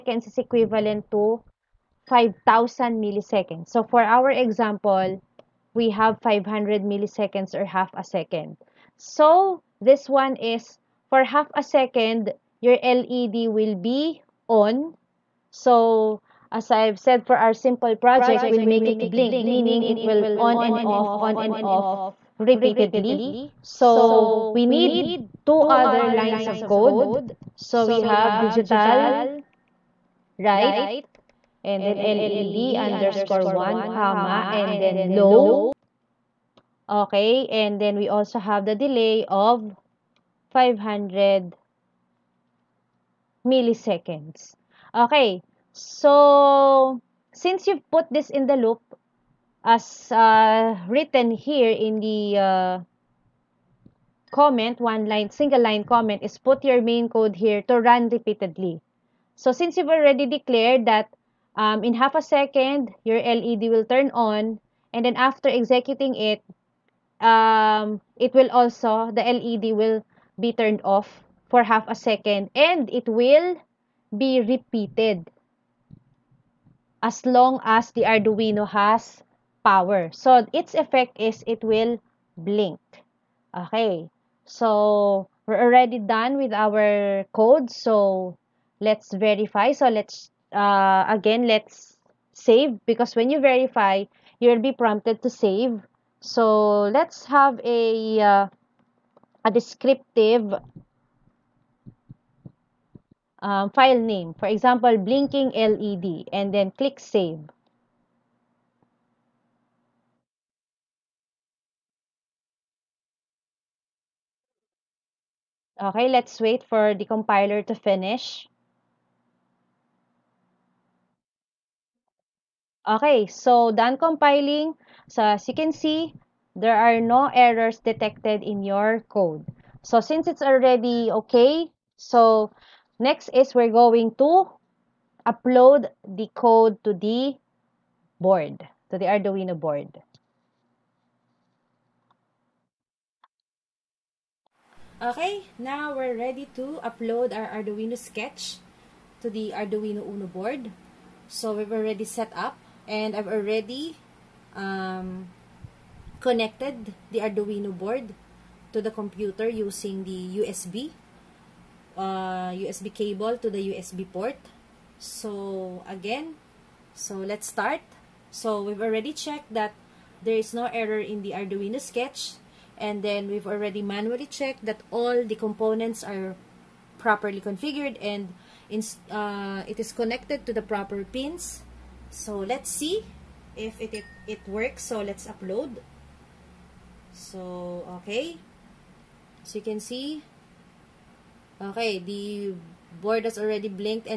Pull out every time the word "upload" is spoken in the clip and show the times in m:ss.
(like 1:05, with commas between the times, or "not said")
2:15, 2:26, 3:05.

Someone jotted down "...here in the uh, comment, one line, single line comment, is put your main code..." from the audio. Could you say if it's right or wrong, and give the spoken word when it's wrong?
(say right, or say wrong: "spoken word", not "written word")
right.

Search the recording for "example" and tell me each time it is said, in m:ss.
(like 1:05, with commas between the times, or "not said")
0:04, 1:44.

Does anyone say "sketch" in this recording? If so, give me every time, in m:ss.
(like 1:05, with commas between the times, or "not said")
2:27, 2:51.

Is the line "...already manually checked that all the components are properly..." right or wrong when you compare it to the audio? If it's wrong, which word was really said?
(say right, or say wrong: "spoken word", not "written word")
right.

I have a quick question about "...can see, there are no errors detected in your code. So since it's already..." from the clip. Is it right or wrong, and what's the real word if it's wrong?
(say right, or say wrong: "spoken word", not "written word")
right.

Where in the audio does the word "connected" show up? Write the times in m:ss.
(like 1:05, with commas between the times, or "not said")
2:36, 2:59.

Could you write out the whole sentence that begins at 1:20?
So, its effect is it will blink.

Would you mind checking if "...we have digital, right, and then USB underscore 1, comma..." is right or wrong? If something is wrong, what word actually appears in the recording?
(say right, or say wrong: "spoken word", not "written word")
wrong: "LED", not "USB".